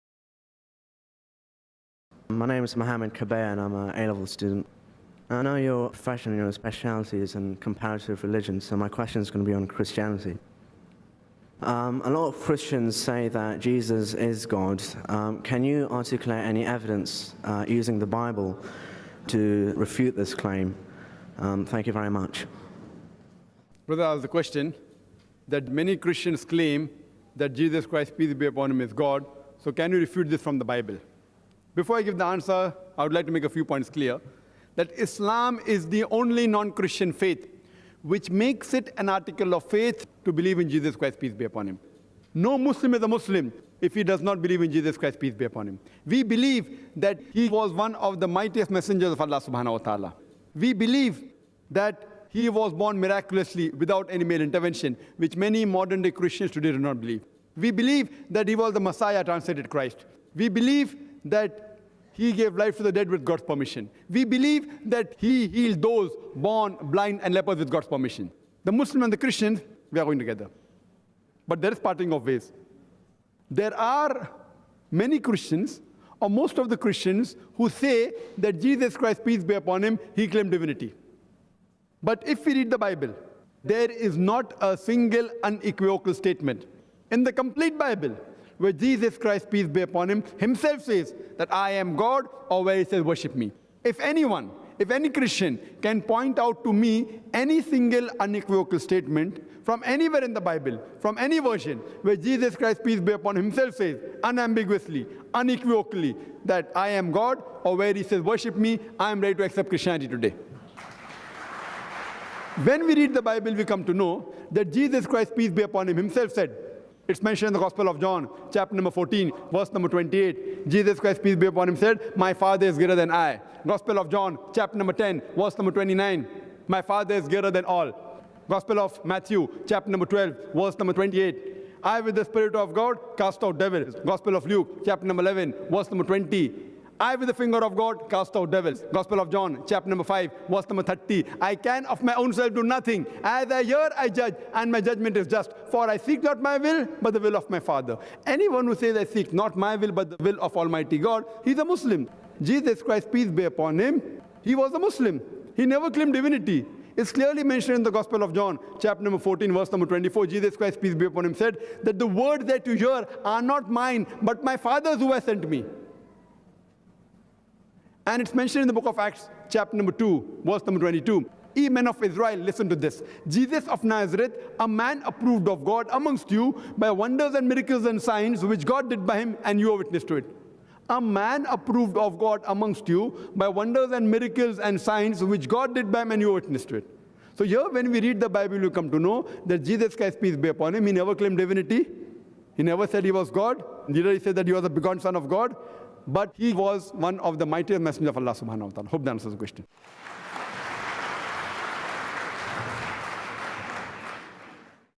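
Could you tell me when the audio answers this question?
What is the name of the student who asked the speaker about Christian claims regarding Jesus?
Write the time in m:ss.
0:02.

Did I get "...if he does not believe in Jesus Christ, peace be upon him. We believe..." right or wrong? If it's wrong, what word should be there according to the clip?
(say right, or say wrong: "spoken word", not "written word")
right.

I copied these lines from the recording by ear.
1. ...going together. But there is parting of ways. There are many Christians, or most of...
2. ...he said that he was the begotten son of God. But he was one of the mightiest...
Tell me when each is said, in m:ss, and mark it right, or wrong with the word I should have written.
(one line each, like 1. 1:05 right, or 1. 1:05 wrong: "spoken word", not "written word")
1. 1:10 right
2. 3:14 right.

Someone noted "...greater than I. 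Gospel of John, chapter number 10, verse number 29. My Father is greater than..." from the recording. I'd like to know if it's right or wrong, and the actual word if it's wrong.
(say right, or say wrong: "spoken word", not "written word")
right.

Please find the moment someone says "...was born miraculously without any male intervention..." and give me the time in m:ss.
0:52.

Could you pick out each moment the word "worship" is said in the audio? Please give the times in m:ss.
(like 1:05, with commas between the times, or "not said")
1:33, 1:48.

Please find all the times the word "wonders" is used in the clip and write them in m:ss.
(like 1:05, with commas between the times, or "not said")
2:56, 3:03.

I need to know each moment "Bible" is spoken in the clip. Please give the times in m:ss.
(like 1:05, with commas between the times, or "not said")
0:18, 0:30, 1:22, 1:27, 1:40, 1:53, 3:08.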